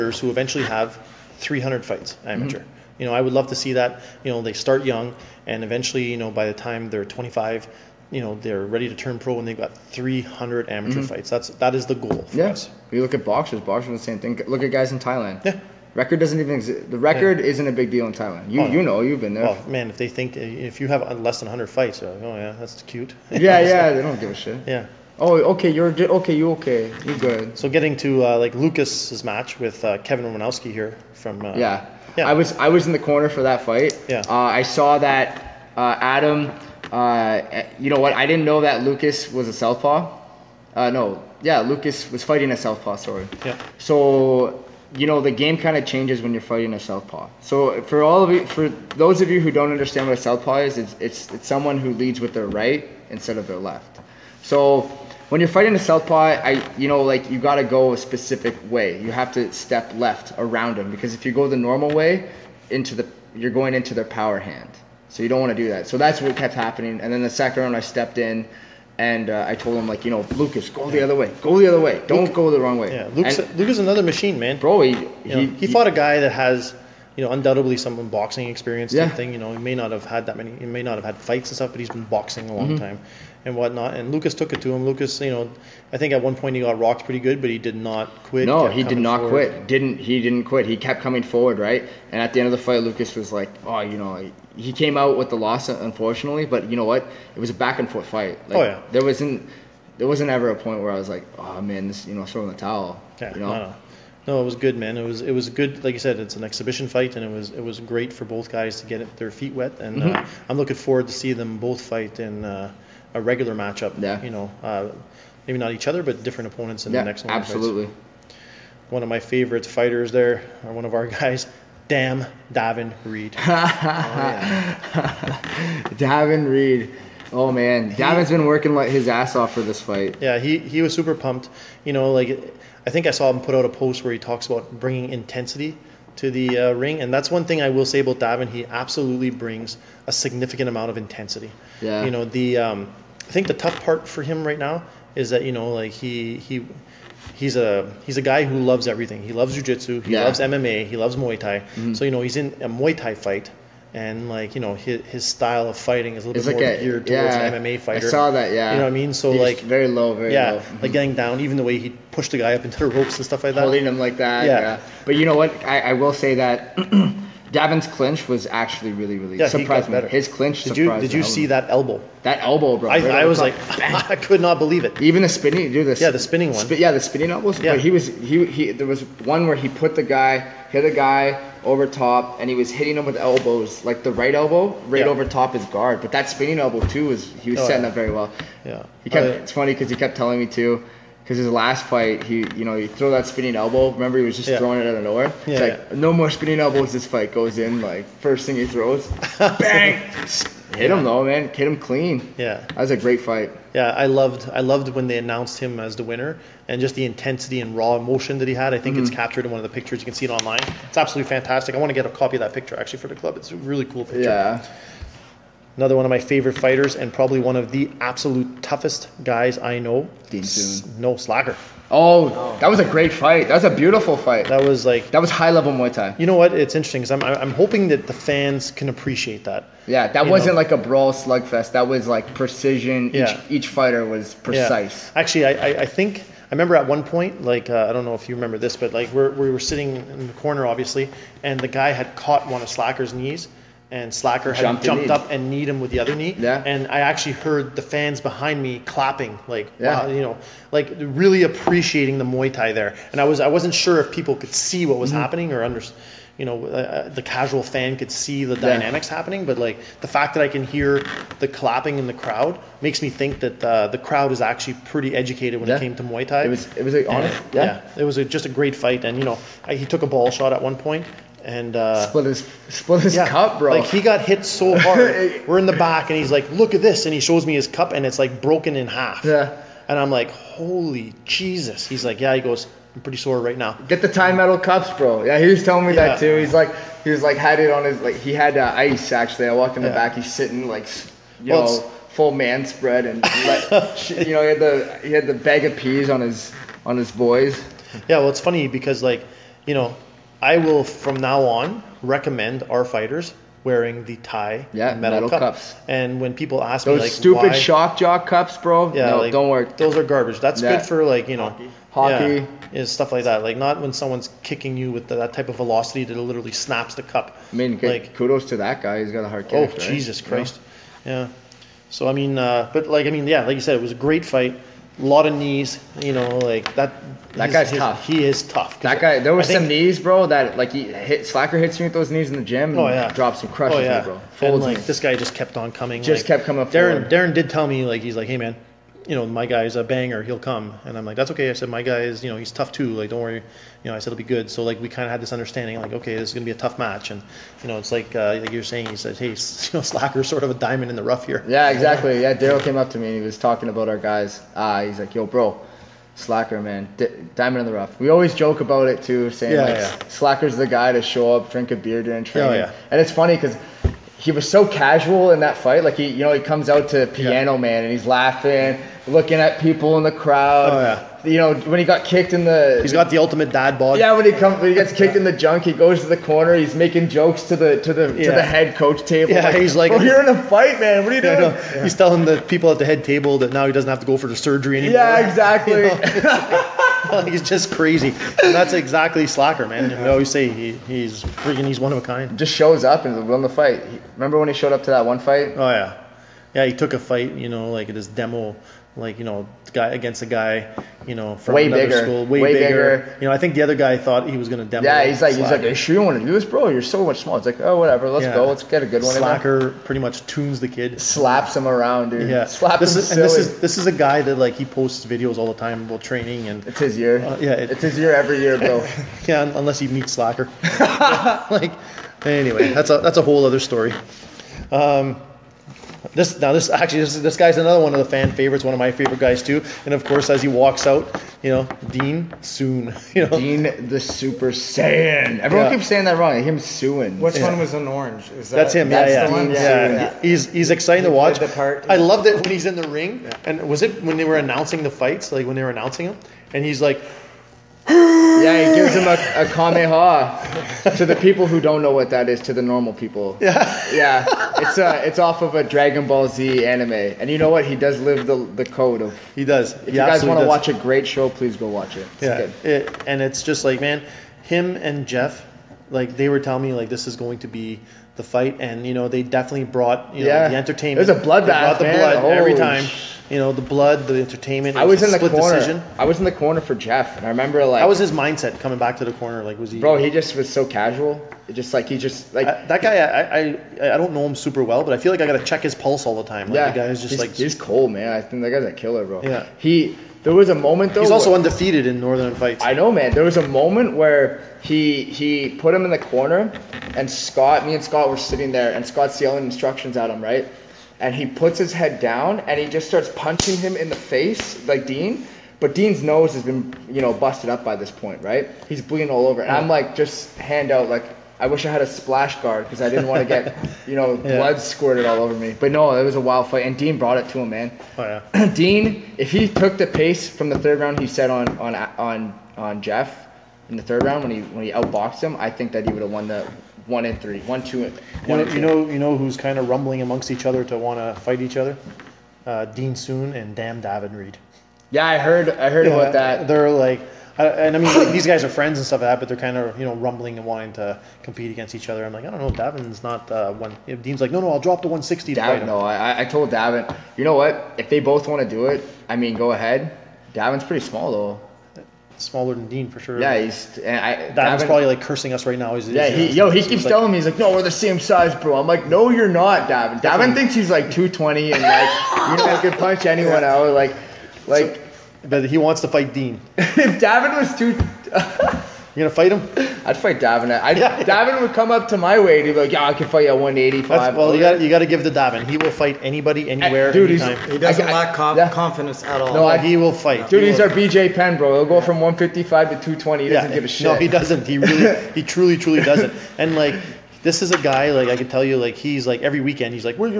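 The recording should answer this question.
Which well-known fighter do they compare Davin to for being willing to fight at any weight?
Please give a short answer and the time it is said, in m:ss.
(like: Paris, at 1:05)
BJ Penn, at 9:40.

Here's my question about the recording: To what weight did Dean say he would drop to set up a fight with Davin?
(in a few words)
160.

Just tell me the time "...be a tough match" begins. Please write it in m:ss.
5:46.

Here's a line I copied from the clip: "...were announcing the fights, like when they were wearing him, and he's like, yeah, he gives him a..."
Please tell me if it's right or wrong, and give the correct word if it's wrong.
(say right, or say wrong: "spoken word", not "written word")
wrong: "announcing", not "wearing".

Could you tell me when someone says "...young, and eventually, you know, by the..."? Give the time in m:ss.
0:04.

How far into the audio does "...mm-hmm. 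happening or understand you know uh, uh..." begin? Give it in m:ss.
4:15.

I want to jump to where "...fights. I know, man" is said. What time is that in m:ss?
8:12.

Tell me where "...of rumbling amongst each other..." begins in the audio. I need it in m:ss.
8:49.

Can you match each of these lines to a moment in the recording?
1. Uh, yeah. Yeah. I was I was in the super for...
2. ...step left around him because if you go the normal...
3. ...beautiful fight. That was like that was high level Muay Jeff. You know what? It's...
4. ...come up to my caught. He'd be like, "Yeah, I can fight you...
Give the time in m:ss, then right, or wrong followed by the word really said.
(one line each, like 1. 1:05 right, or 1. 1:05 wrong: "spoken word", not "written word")
1. 0:31 wrong: "corner", not "super"
2. 0:59 right
3. 3:43 wrong: "Thai", not "Jeff"
4. 9:31 wrong: "weight", not "caught".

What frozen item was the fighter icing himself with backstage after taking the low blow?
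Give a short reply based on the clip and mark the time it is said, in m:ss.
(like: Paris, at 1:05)
Bag of peas, at 4:55.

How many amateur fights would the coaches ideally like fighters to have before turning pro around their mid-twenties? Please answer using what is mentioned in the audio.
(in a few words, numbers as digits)
300.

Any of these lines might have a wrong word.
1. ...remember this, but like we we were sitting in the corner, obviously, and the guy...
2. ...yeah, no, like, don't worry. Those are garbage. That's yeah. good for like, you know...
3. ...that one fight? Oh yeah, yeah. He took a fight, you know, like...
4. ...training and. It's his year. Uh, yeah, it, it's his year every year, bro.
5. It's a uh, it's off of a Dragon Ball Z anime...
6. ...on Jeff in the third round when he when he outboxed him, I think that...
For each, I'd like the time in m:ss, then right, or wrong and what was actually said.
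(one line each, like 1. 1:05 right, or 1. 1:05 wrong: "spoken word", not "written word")
1. 3:58 right
2. 5:08 right
3. 6:34 right
4. 6:56 right
5. 7:34 right
6. 8:42 right.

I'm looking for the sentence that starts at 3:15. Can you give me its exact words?
Yeah, it's like no more spinning elbows.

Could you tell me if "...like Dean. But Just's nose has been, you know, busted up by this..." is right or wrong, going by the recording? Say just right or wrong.
wrong.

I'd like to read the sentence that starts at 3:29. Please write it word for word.
it's captured in one of the pictures.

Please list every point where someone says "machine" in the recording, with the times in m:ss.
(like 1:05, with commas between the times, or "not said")
1:14.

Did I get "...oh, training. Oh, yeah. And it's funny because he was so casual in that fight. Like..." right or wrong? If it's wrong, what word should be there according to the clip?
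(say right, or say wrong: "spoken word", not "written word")
right.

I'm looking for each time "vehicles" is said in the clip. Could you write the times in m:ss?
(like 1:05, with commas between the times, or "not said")
not said.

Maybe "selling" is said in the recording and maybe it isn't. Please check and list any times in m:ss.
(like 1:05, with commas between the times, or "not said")
not said.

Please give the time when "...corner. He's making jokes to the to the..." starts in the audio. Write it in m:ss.
6:16.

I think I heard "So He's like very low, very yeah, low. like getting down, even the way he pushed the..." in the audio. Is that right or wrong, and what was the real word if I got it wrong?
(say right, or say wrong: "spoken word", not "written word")
right.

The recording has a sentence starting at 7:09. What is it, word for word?
And of course, as he walks out, you know, Dean soon.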